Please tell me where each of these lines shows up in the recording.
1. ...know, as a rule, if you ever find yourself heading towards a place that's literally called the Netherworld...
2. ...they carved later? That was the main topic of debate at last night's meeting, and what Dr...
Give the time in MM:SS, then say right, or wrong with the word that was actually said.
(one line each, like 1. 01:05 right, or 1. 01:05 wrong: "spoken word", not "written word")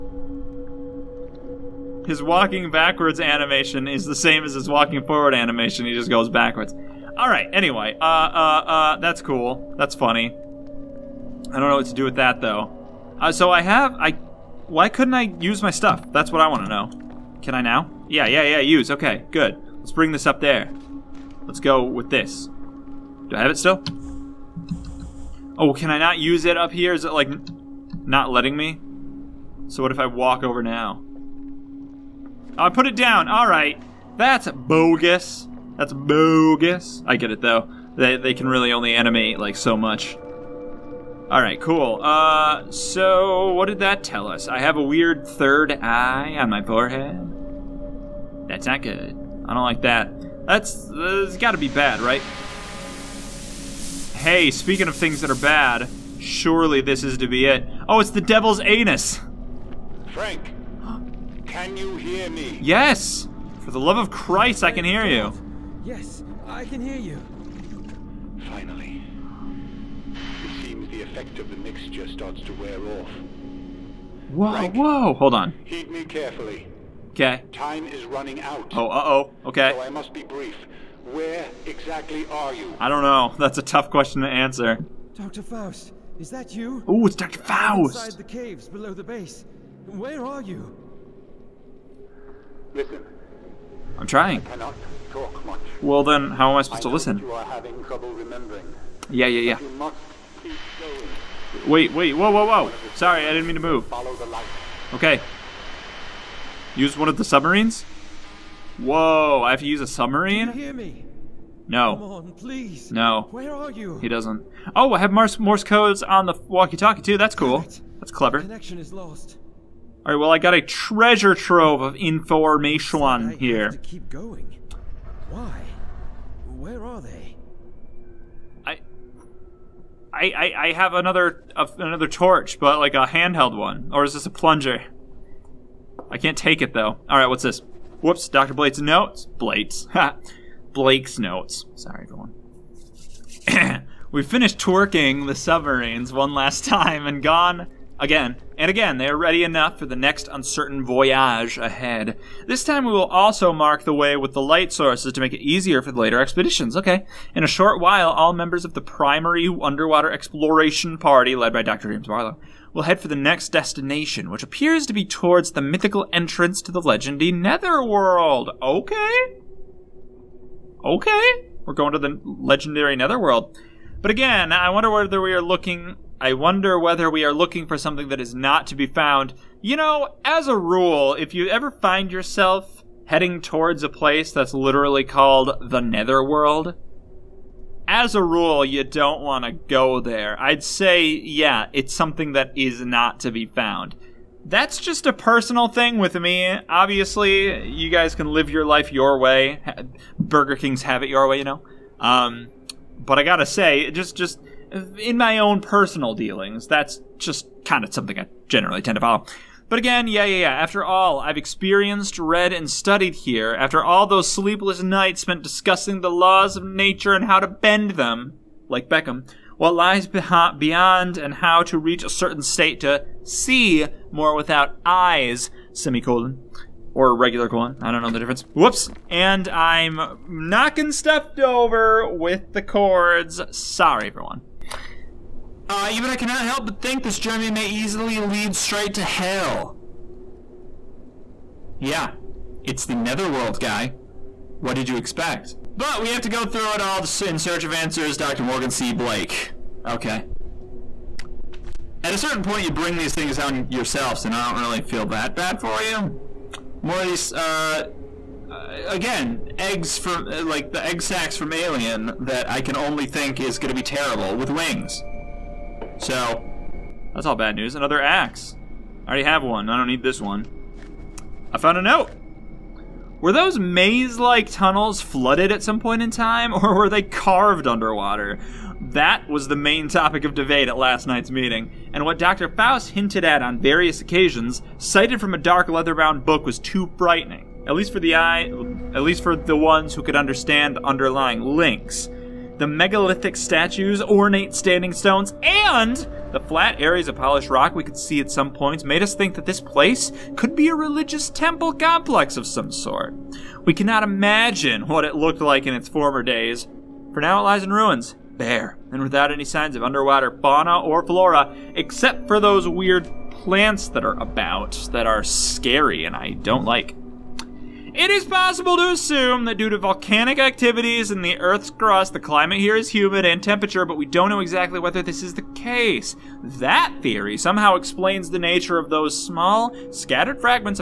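1. 02:59 right
2. 04:36 wrong: "underwater", not "later".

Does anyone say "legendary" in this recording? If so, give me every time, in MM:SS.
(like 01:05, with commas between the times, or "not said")
02:46, 02:52.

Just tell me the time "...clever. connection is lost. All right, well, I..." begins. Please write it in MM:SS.
01:58.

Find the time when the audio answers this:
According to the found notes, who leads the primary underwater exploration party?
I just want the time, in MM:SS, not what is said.
02:41.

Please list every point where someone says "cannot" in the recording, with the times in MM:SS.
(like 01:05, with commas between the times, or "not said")
01:34, 03:56, 05:03.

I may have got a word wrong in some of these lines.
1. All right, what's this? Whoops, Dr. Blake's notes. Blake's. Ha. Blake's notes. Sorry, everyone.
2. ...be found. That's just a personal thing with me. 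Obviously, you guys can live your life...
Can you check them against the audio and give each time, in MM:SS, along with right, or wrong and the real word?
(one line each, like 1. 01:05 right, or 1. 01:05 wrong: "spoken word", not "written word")
1. 02:17 right
2. 03:13 right.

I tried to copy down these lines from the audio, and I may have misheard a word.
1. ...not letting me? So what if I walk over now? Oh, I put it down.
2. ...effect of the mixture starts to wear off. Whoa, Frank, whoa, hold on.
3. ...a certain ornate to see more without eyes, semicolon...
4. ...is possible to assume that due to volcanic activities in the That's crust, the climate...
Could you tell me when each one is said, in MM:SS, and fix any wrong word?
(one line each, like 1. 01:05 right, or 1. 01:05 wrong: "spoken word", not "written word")
1. 00:28 right
2. 01:11 right
3. 03:42 wrong: "state", not "ornate"
4. 05:18 wrong: "Earth", not "That".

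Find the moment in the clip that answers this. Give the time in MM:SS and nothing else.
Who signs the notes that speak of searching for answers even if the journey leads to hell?
04:08.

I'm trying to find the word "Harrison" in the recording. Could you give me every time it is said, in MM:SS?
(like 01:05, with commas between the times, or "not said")
not said.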